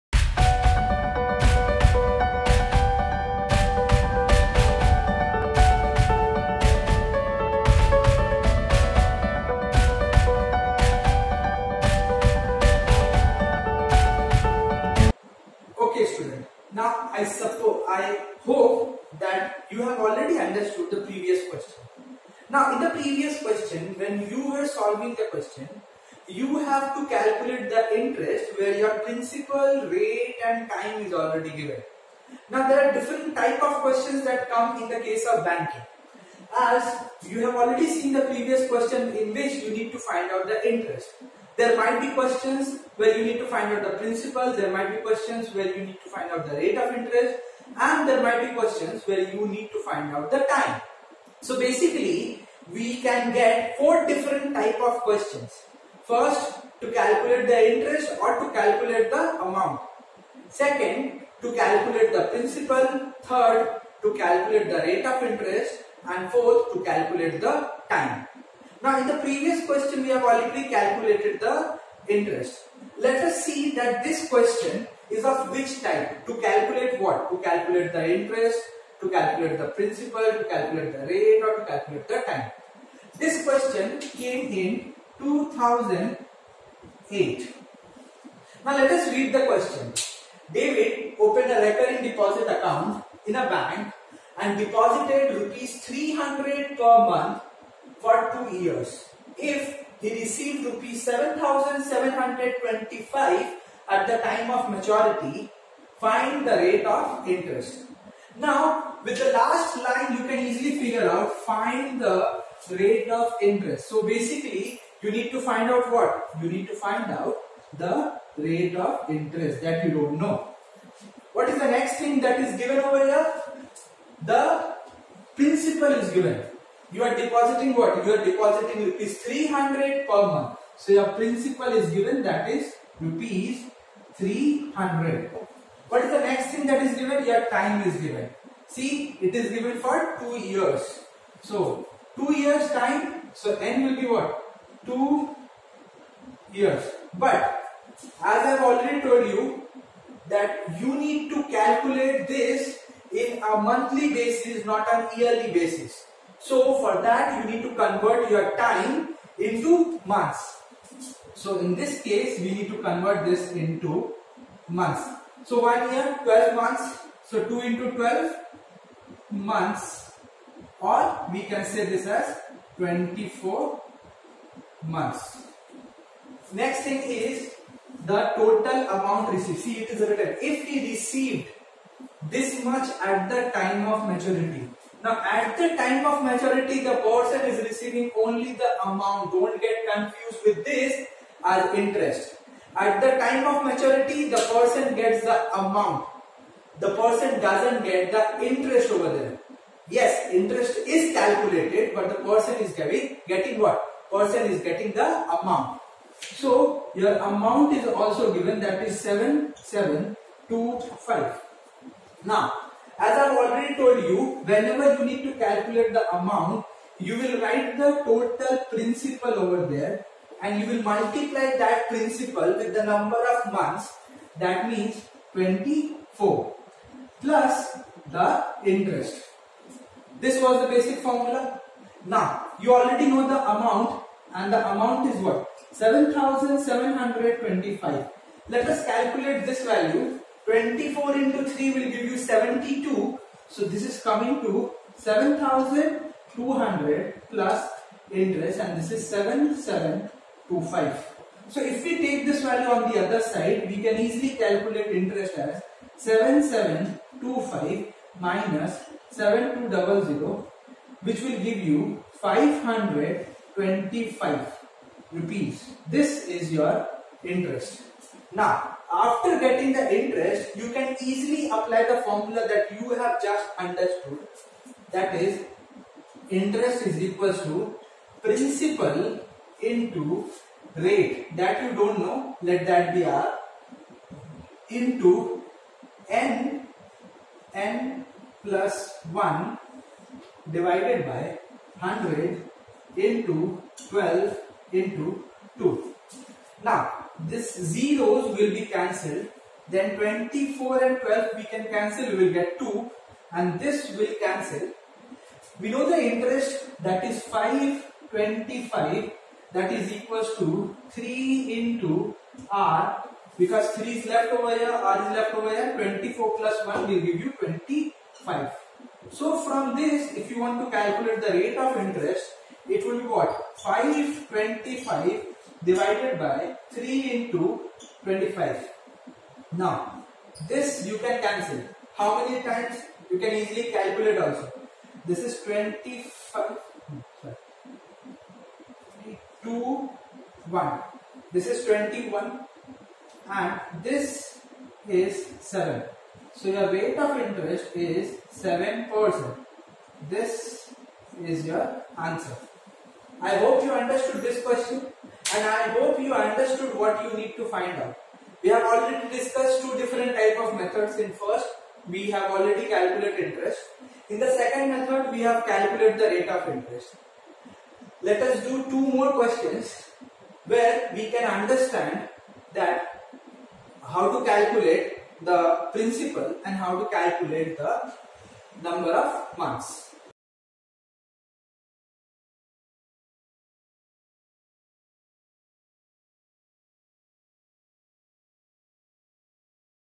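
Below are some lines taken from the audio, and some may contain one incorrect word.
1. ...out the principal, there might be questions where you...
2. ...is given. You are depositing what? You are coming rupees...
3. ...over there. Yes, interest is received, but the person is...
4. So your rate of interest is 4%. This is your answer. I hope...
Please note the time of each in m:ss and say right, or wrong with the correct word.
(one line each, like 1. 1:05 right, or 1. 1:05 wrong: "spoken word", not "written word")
1. 0:43 right
2. 2:05 wrong: "depositing", not "coming"
3. 3:18 wrong: "calculated", not "received"
4. 5:46 wrong: "7", not "4".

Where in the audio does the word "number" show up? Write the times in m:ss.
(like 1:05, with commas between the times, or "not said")
3:42, 6:18.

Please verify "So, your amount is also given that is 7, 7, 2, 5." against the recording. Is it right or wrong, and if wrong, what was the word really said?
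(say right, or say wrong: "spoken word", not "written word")
right.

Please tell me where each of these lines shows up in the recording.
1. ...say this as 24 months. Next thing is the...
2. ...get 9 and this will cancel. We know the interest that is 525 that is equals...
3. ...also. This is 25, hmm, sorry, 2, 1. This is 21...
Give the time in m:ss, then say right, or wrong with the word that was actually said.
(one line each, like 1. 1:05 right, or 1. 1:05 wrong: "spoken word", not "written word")
1. 2:51 right
2. 5:02 wrong: "2", not "9"
3. 5:34 right.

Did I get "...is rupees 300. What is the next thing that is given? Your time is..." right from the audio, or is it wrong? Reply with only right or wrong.
right.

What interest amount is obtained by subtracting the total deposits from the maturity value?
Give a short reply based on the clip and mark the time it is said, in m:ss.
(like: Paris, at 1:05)
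Rs 525, at 4:22.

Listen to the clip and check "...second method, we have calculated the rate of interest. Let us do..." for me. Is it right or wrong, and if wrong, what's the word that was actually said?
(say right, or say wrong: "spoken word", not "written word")
right.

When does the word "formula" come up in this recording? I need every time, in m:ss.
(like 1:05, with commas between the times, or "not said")
3:50, 4:32.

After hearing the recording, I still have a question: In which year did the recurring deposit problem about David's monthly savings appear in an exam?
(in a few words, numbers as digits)
2008.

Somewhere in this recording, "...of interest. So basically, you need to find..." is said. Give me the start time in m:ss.
1:53.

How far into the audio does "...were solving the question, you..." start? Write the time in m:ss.
0:24.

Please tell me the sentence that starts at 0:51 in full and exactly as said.
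So basically, we can get four different type of questions.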